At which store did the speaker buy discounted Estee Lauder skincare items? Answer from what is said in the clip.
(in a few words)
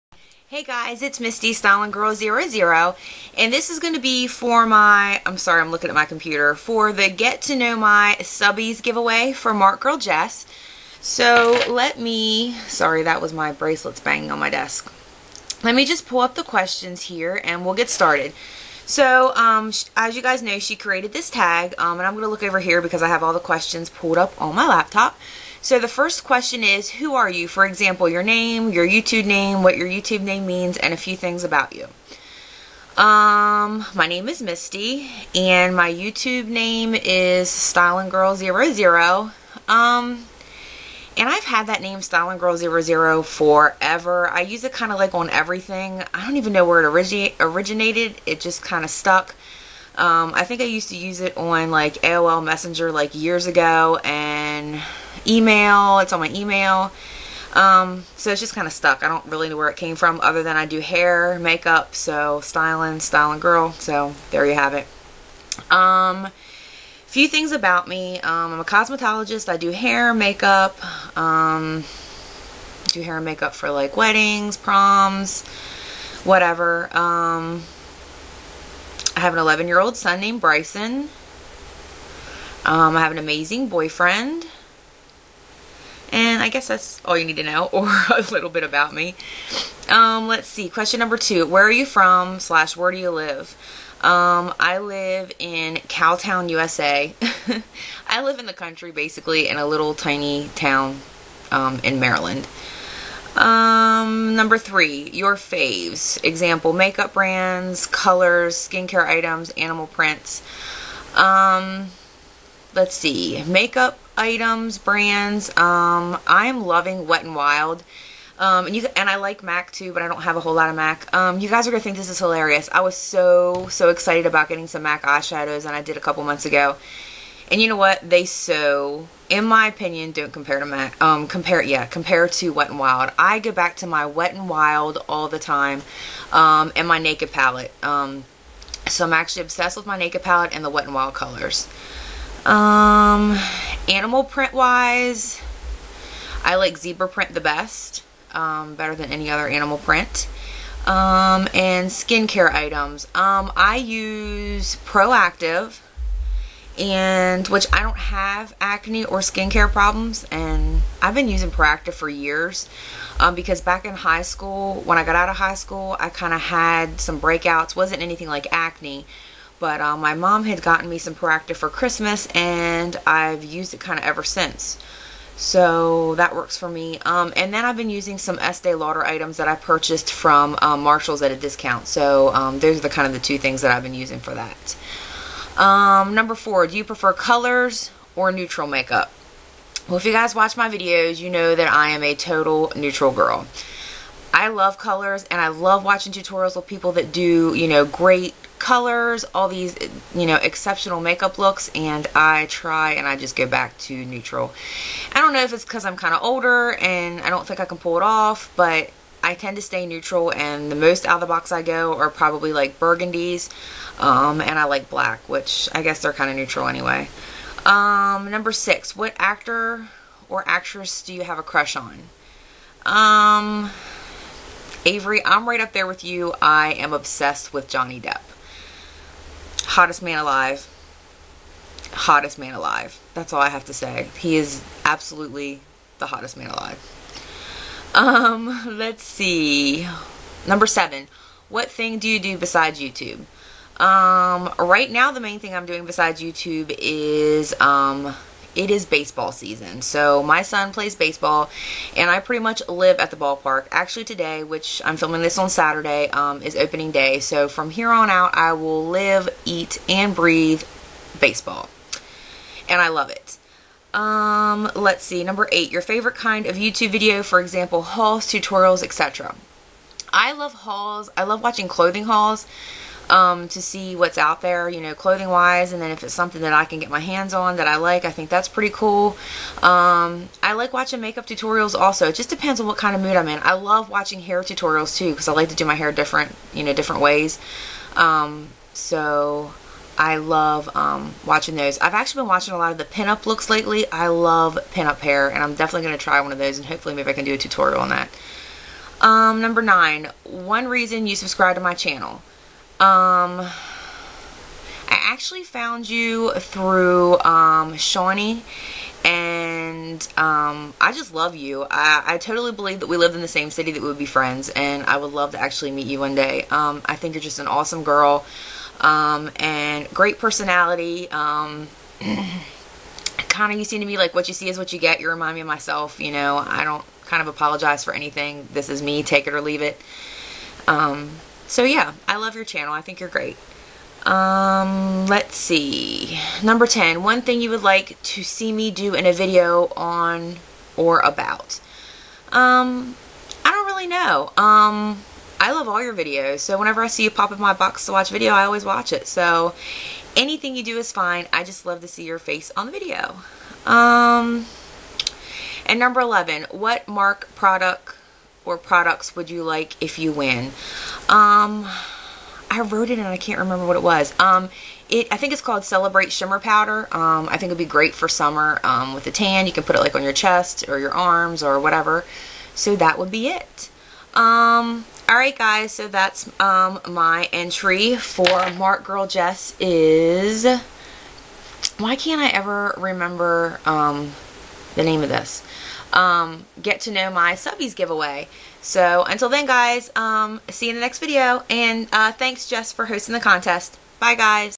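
Marshalls.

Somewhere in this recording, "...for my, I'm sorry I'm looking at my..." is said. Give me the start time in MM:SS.
00:04.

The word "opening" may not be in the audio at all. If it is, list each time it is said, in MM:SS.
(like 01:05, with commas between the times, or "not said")
04:16.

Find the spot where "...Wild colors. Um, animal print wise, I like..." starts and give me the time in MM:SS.
02:20.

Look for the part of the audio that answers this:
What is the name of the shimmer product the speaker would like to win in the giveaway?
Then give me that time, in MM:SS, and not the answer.
06:05.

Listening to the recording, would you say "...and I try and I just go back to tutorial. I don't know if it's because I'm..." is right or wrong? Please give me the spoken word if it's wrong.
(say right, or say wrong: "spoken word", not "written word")
wrong: "neutral", not "tutorial".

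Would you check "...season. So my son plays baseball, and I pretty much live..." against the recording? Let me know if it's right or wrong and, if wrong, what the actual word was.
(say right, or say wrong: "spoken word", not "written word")
right.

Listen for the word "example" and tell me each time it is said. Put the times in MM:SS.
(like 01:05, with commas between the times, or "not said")
00:27, 01:46, 04:27.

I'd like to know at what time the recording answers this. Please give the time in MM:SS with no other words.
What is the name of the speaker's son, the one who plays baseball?
01:20.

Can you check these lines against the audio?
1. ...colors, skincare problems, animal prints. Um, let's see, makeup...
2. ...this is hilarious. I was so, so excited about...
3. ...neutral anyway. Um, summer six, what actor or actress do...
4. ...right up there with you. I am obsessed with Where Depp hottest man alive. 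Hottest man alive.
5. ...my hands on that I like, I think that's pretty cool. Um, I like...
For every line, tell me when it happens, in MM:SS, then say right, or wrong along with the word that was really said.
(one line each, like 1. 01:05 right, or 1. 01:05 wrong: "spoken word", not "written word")
1. 01:47 wrong: "items", not "problems"
2. 02:01 right
3. 03:36 wrong: "number", not "summer"
4. 03:45 wrong: "Johnny", not "Where"
5. 04:36 right.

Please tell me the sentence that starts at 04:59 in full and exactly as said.
Um, number nine, one reason you subscribe to my channel.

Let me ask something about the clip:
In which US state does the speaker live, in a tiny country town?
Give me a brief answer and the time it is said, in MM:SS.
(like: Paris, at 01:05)
Maryland, at 01:41.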